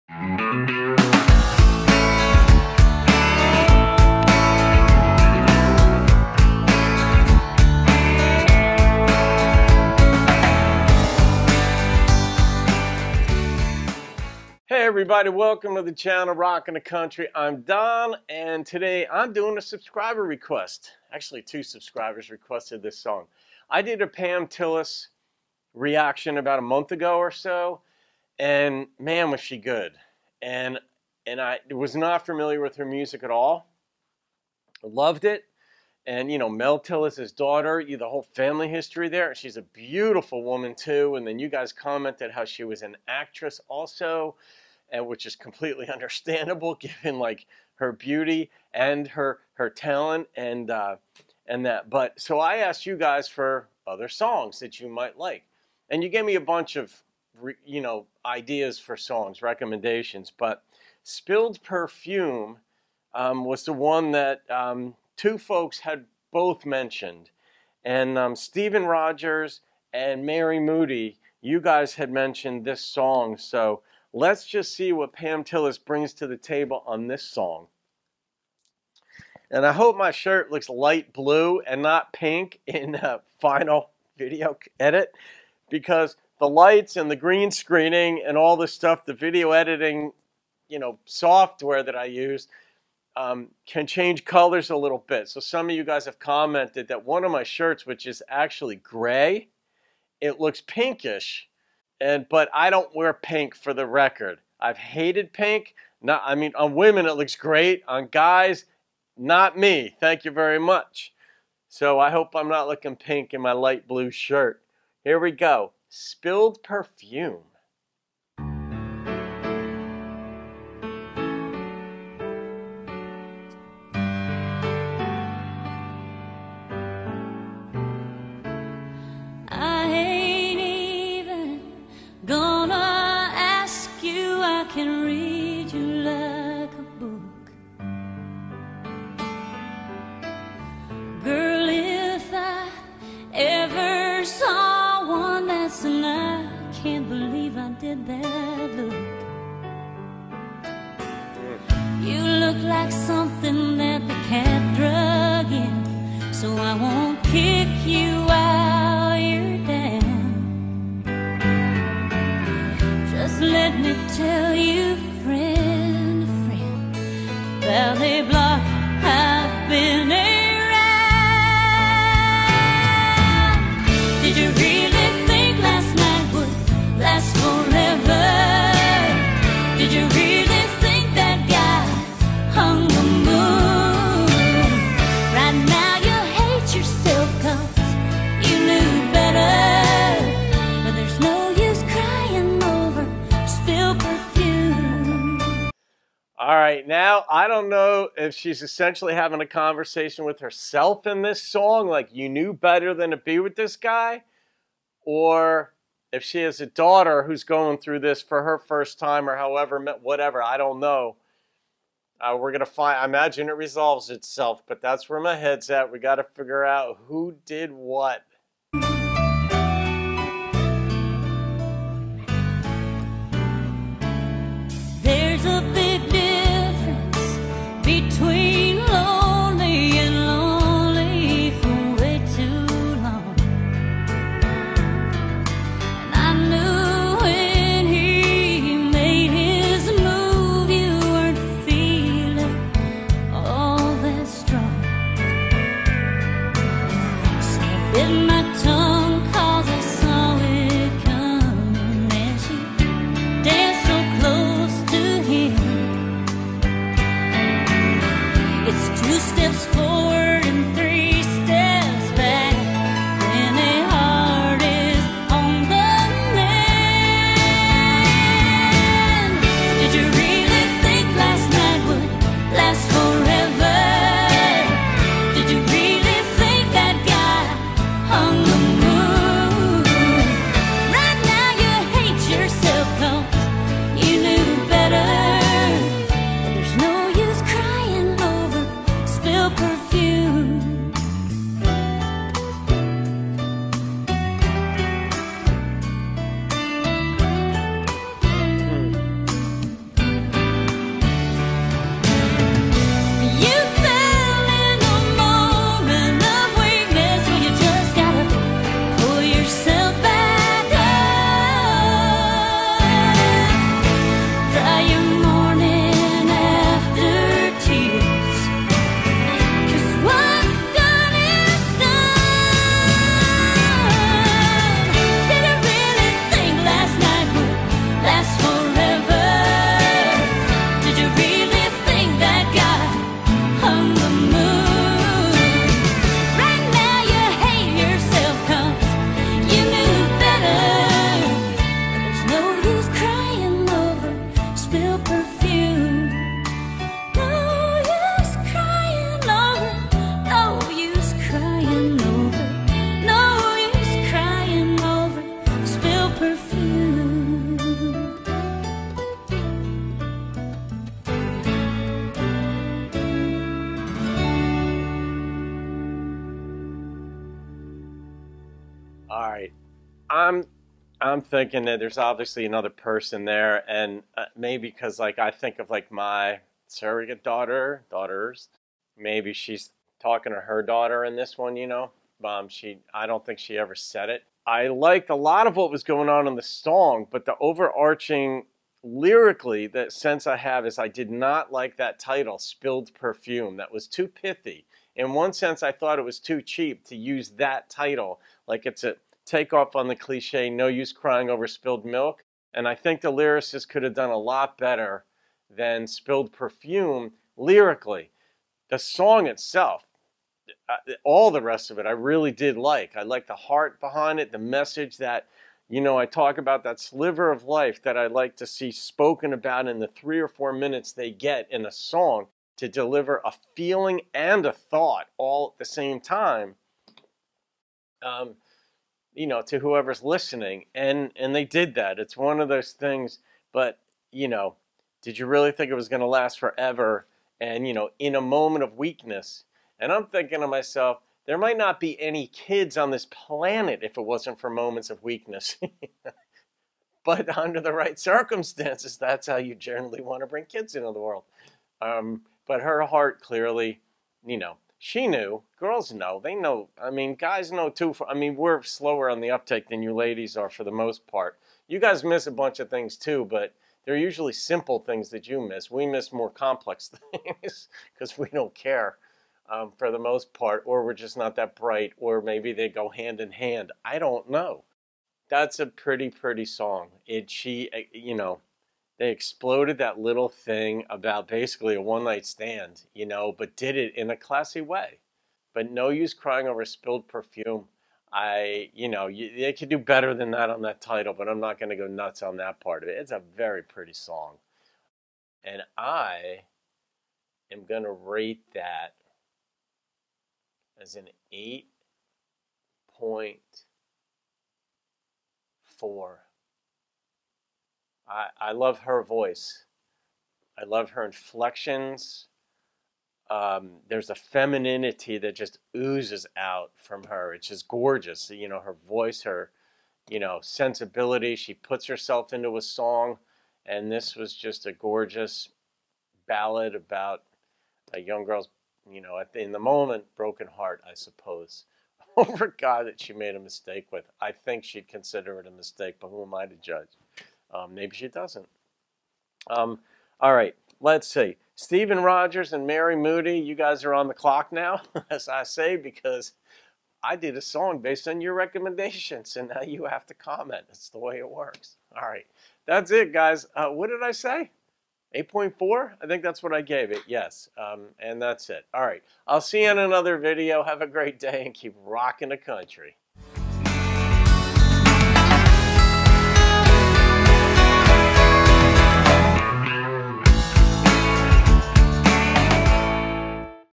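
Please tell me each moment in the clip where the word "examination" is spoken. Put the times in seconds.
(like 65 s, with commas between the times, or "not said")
not said.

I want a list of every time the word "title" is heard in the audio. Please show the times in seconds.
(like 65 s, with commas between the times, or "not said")
391 s, 397 s, 490 s.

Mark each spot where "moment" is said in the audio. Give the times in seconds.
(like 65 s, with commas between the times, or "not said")
438 s, 444 s, 529 s.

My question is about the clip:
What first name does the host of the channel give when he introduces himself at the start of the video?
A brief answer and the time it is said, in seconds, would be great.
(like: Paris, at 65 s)
Don, at 17 s.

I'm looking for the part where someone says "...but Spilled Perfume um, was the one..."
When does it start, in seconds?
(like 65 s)
60 s.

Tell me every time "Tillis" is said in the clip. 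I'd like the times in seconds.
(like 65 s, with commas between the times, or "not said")
24 s, 36 s, 75 s.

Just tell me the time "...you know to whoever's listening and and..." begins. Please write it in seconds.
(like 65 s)
429 s.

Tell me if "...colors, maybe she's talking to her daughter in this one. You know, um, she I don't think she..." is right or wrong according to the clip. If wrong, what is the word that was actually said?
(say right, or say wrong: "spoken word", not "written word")
wrong: "daughters", not "colors".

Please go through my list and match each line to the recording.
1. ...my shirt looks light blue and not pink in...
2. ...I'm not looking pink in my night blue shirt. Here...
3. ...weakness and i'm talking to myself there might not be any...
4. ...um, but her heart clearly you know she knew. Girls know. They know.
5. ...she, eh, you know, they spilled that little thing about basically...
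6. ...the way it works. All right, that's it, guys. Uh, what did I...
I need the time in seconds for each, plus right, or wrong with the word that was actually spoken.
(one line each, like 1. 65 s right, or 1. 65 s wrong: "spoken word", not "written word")
1. 79 s right
2. 112 s wrong: "light", not "night"
3. 438 s wrong: "thinking", not "talking"
4. 451 s right
5. 477 s wrong: "exploded", not "spilled"
6. 550 s right.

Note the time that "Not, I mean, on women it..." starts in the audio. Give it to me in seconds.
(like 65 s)
106 s.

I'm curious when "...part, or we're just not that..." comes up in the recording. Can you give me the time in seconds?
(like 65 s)
470 s.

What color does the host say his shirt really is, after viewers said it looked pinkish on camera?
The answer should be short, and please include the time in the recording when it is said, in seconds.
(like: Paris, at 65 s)
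gray, at 98 s.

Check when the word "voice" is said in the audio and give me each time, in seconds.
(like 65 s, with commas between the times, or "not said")
509 s, 518 s.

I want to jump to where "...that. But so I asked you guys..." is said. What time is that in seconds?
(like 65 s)
51 s.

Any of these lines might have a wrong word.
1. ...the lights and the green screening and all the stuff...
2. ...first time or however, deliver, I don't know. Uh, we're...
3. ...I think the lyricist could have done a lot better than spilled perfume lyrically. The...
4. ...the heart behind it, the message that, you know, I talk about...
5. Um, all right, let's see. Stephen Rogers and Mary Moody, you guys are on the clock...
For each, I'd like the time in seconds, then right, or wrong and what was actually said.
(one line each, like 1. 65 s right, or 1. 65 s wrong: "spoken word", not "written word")
1. 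86 s right
2. 208 s wrong: "whatever", not "deliver"
3. 402 s right
4. 413 s right
5. 539 s right.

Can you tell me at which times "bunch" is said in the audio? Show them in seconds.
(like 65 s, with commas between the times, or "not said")
56 s, 462 s.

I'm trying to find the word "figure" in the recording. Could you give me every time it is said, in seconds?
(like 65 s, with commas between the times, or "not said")
216 s.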